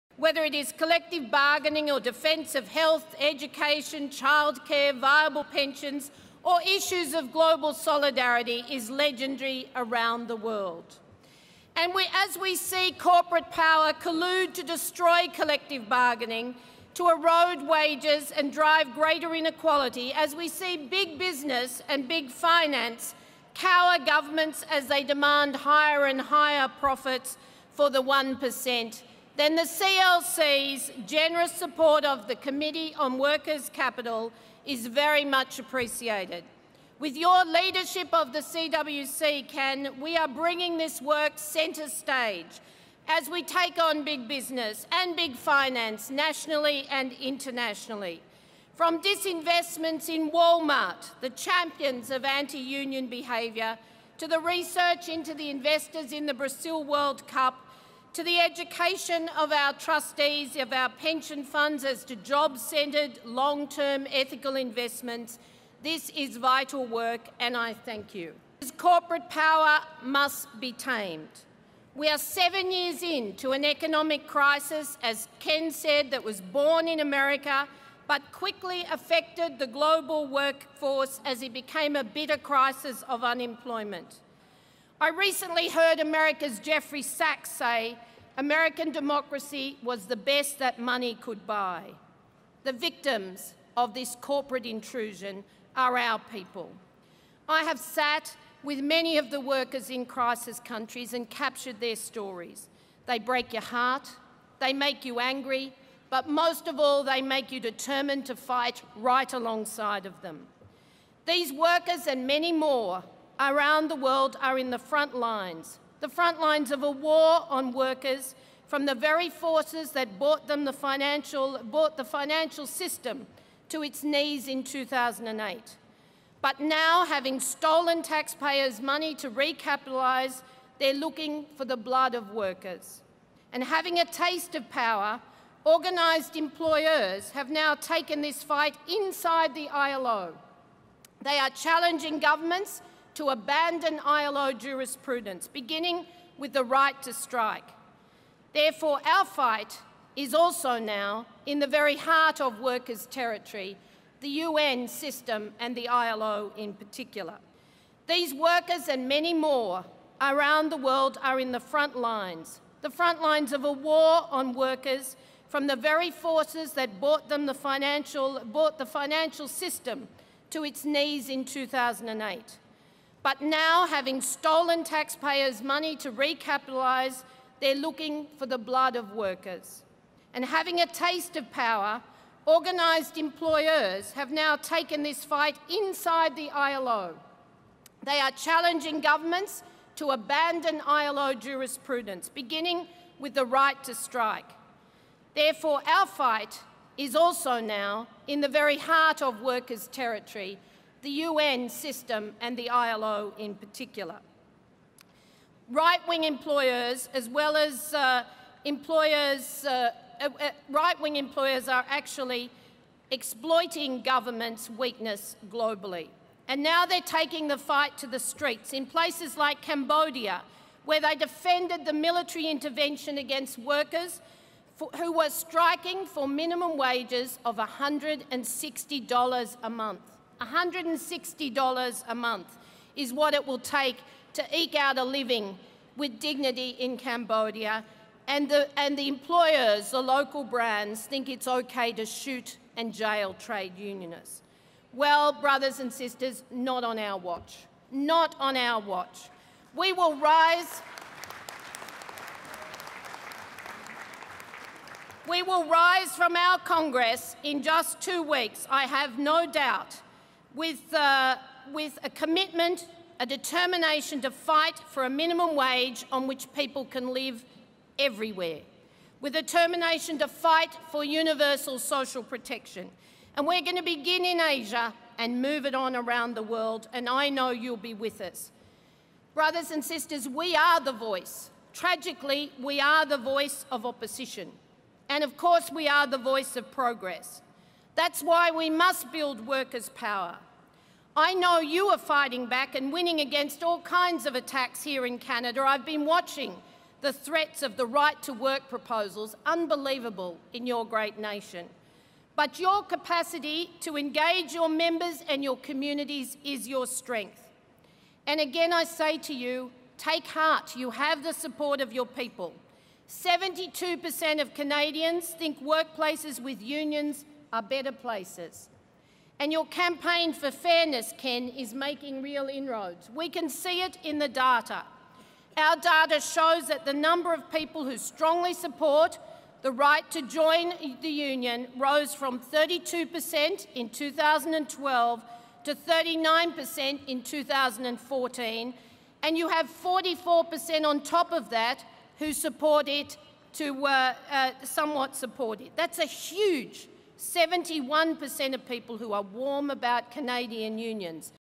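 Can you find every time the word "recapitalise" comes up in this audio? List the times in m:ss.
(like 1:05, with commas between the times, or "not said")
2:09, 2:56.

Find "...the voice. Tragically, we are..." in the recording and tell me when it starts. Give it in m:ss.
4:40.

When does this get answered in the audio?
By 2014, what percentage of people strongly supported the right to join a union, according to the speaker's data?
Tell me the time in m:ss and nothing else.
5:35.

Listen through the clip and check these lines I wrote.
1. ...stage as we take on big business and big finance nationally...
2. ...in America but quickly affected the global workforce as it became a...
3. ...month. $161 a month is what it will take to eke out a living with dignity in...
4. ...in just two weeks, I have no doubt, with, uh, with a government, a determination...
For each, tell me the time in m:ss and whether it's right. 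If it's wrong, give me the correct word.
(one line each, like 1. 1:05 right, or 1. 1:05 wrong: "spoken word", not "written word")
1. 0:41 right
2. 1:16 right
3. 3:49 wrong: "160", not "161"
4. 4:17 wrong: "commitment", not "government".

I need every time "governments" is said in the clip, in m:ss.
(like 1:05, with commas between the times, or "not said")
0:24, 2:22, 3:09, 3:34.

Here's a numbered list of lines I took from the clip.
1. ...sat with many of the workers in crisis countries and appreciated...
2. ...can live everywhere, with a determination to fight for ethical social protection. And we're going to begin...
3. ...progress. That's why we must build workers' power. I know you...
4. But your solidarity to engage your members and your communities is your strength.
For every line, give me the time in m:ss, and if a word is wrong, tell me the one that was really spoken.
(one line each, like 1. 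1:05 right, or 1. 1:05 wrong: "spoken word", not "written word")
1. 1:37 wrong: "captured", not "appreciated"
2. 4:26 wrong: "universal", not "ethical"
3. 4:46 right
4. 5:02 wrong: "capacity", not "solidarity".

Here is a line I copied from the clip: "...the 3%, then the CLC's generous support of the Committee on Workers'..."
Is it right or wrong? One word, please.
wrong.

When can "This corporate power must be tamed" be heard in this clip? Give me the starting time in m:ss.
1:08.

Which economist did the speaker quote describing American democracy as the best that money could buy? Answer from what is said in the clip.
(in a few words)
Jeffrey Sachs.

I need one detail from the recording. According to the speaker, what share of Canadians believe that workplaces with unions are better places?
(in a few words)
72%.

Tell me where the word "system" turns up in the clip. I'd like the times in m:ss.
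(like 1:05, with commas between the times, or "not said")
2:02, 2:34, 2:49, 3:21.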